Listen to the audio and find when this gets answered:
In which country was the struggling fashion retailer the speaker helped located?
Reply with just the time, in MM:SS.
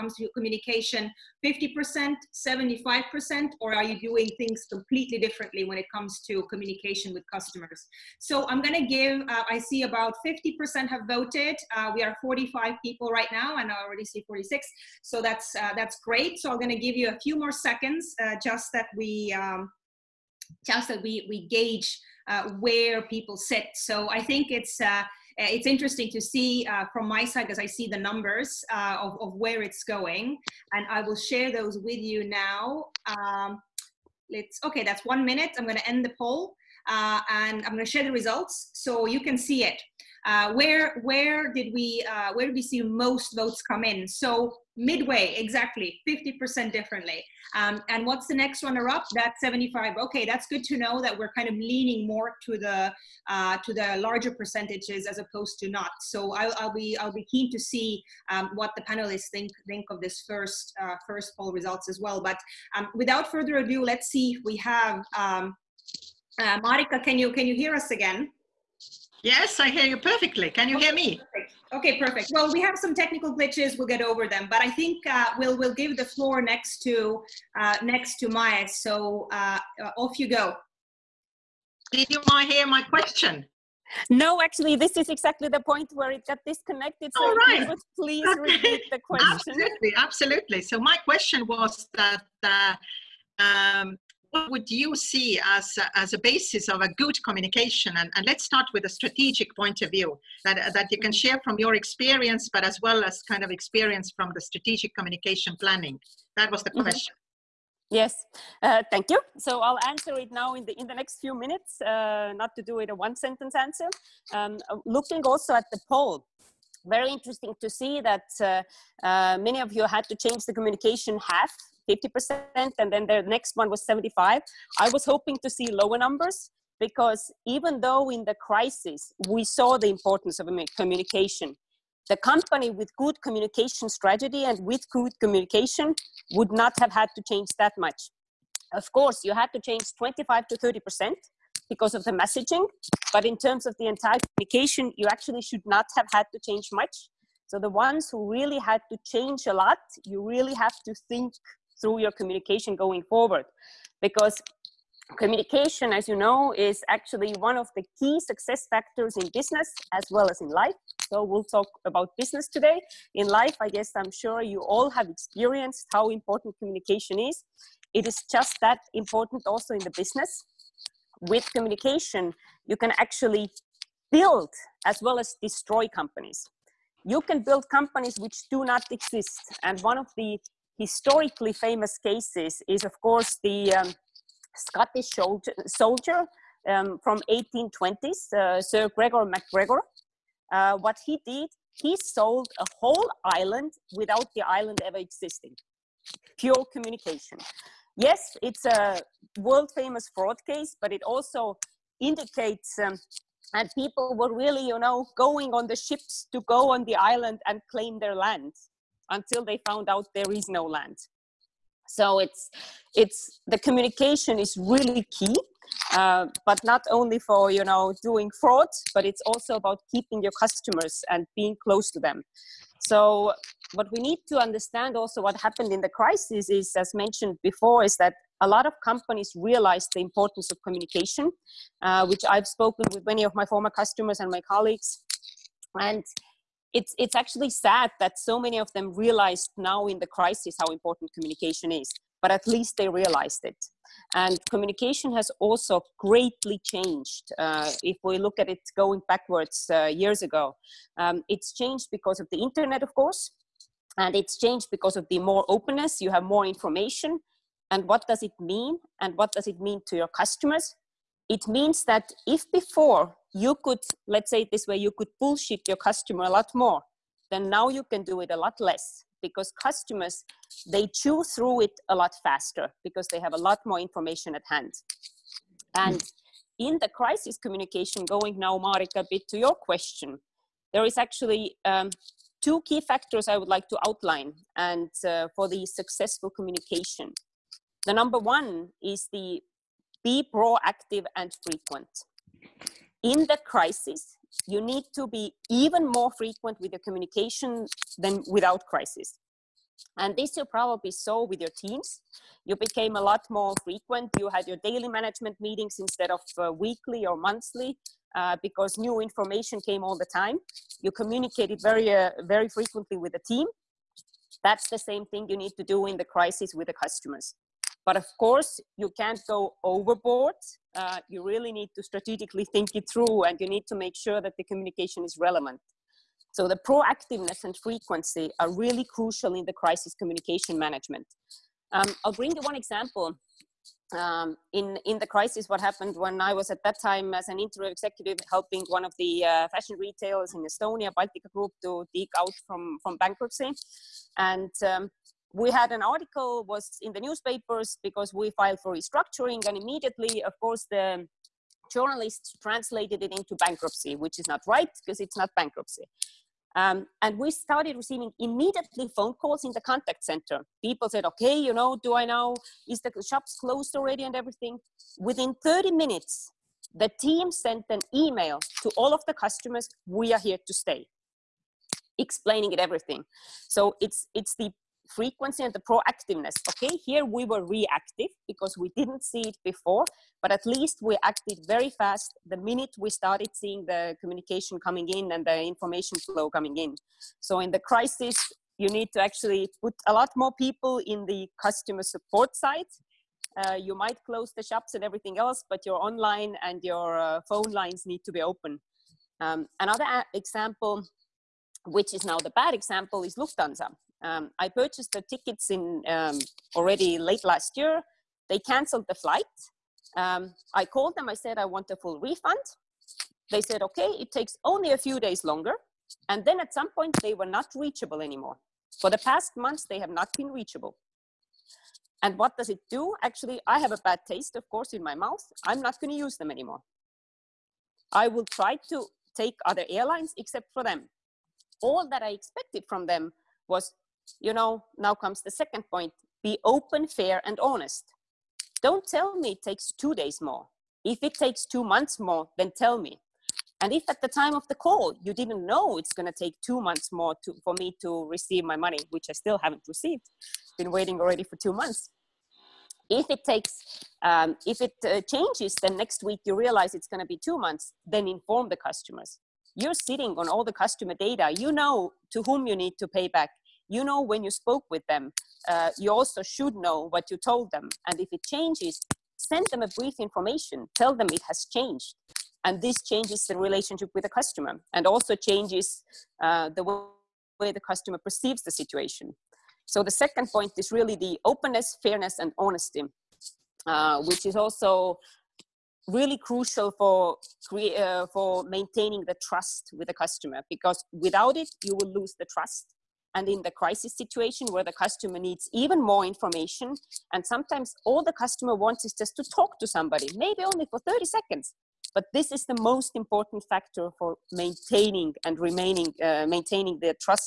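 05:40.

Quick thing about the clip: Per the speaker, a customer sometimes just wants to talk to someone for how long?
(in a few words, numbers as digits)
30 seconds.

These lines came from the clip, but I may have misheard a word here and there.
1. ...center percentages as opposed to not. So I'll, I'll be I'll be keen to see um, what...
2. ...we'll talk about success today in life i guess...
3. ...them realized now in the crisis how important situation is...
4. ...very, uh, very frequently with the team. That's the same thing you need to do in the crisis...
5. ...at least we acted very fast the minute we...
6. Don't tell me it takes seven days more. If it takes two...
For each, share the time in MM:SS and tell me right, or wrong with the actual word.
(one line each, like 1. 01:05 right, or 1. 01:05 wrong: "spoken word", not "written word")
1. 00:53 wrong: "larger", not "center"
2. 02:41 wrong: "business", not "success"
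3. 03:58 wrong: "communication", not "situation"
4. 05:11 right
5. 06:20 right
6. 07:18 wrong: "two", not "seven".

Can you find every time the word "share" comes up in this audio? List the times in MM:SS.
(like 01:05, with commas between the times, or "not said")
00:31, 00:37, 01:41.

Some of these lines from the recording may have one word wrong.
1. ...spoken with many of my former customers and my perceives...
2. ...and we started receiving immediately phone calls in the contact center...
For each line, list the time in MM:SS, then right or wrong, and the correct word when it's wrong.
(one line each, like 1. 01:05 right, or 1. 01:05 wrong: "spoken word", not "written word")
1. 03:52 wrong: "colleagues", not "perceives"
2. 05:57 right.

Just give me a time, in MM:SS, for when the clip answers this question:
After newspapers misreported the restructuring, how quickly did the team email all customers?
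06:05.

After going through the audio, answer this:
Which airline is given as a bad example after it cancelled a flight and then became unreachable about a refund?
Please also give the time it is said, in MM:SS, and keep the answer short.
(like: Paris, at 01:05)
Lufthansa, at 06:43.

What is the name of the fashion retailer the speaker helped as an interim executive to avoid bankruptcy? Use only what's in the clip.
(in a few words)
Baltica Group.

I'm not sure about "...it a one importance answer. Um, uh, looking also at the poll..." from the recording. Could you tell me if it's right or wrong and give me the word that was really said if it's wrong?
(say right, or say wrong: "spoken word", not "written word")
wrong: "sentence", not "importance".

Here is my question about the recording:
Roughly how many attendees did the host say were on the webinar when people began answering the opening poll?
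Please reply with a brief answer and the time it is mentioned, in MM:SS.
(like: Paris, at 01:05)
45, at 00:12.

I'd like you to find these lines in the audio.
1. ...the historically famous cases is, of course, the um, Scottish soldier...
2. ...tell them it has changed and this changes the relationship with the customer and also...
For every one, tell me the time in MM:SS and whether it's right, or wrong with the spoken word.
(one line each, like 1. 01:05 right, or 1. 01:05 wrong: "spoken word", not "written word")
1. 03:00 right
2. 07:50 right.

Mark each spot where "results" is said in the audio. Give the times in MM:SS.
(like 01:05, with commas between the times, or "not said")
00:38, 01:01.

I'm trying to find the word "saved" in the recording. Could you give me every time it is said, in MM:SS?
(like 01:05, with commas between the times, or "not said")
not said.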